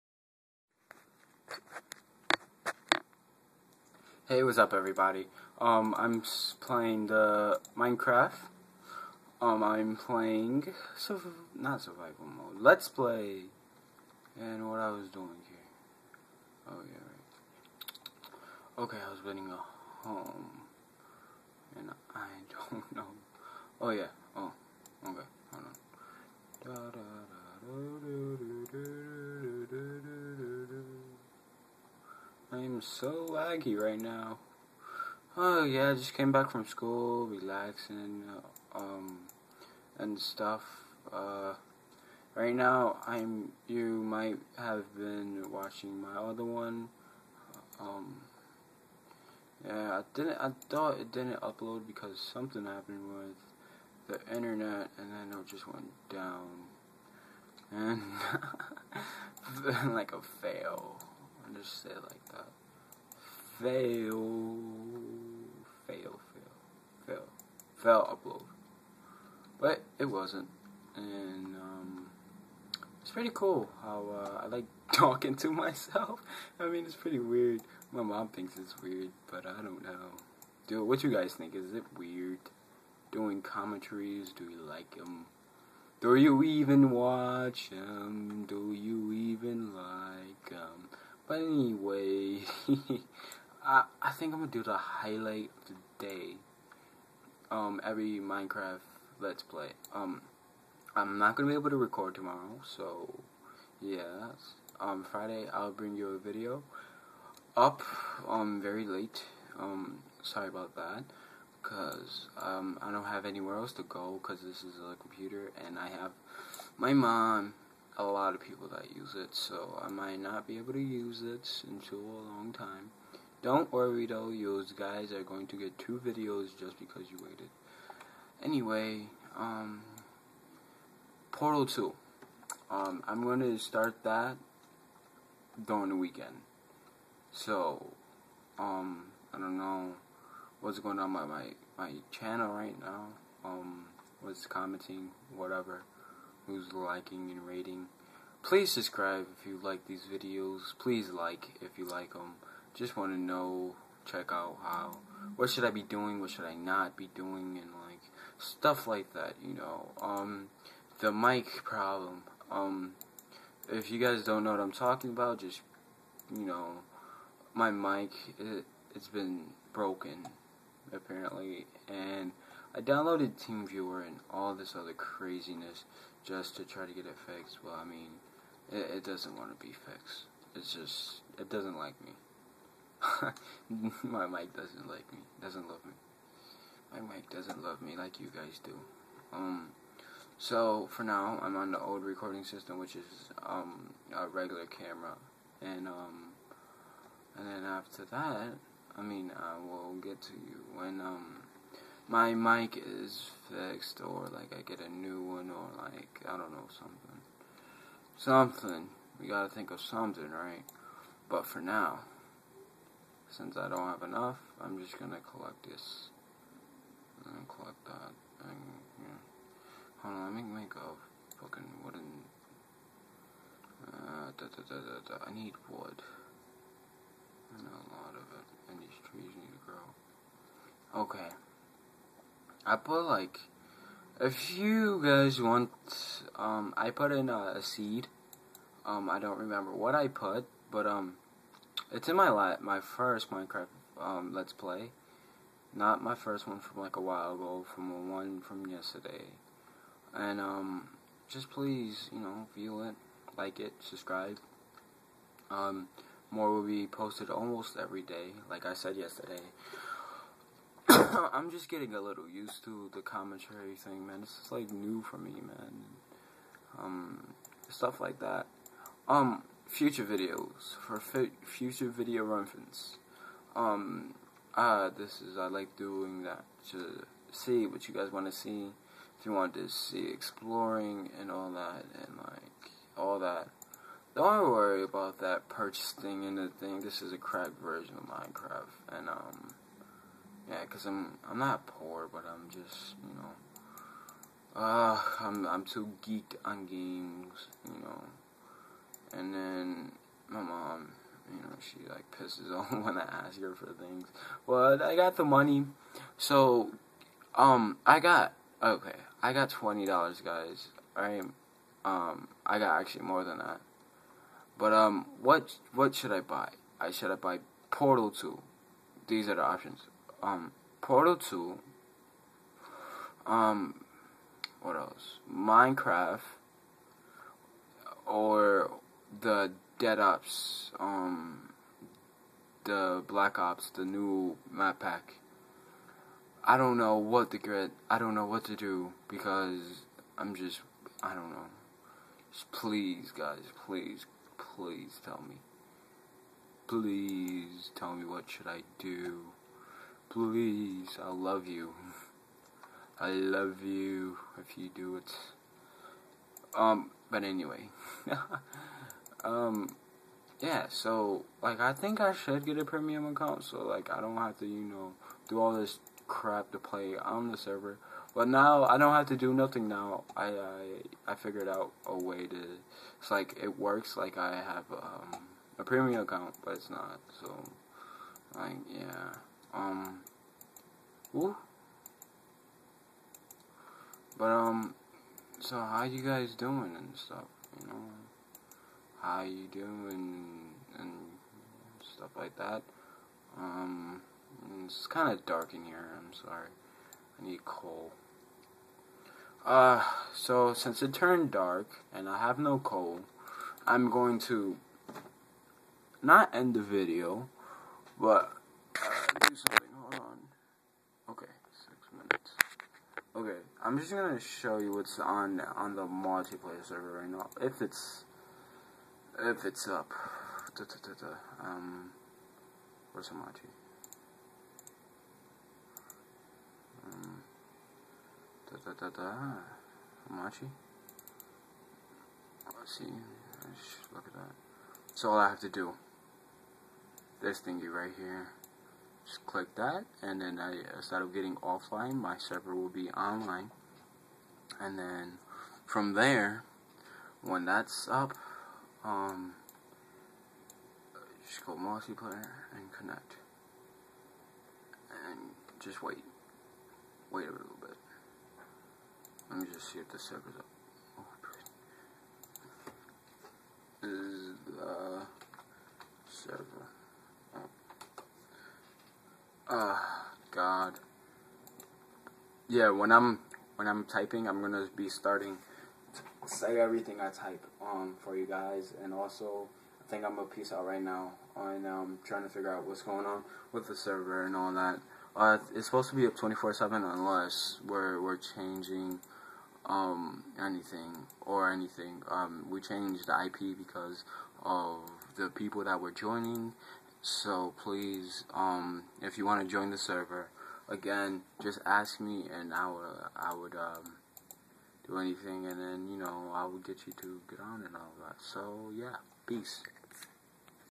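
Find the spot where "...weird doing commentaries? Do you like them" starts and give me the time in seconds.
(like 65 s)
81 s.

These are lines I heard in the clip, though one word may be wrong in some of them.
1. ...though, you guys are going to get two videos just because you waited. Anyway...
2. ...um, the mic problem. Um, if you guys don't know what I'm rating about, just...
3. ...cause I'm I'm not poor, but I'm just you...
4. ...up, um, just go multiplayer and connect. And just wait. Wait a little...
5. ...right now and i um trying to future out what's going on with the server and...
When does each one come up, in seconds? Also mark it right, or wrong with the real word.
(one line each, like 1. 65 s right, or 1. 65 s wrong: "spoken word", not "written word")
1. 124 s right
2. 160 s wrong: "talking", not "rating"
3. 290 s right
4. 447 s right
5. 480 s wrong: "figure", not "future".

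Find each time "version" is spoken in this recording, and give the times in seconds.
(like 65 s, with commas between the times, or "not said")
287 s.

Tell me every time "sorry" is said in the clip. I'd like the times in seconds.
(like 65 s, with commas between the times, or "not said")
110 s, 396 s.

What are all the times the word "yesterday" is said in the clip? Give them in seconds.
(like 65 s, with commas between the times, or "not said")
248 s, 258 s.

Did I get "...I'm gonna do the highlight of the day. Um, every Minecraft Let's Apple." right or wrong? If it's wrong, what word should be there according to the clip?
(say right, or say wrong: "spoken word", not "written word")
wrong: "Play", not "Apple".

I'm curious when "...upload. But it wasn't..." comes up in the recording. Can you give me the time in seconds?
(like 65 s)
68 s.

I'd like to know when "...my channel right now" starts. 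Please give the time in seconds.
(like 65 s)
141 s.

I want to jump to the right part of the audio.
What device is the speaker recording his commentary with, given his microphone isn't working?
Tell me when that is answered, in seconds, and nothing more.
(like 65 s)
194 s.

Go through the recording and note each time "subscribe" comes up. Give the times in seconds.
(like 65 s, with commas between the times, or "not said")
148 s, 253 s.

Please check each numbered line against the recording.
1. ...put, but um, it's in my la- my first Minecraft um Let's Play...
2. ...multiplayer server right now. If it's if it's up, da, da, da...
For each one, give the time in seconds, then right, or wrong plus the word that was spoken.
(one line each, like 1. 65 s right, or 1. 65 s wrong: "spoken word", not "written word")
1. 240 s right
2. 415 s right.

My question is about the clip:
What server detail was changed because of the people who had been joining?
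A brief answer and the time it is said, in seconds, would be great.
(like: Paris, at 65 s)
the IP, at 493 s.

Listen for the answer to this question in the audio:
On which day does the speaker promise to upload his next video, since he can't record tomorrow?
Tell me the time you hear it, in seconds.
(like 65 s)
105 s.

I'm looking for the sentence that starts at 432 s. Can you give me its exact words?
Let's see, Let's look at that.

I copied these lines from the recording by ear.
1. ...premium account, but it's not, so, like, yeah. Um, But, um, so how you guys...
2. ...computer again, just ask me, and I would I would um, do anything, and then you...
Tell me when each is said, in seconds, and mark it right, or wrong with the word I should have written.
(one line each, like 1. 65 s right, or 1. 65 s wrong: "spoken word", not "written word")
1. 375 s right
2. 499 s wrong: "server", not "computer".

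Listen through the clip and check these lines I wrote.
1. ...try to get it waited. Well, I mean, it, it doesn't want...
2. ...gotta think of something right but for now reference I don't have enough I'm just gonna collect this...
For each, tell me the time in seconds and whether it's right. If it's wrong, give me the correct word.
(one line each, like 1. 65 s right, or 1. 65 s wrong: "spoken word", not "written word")
1. 176 s wrong: "fixed", not "waited"
2. 209 s wrong: "since", not "reference".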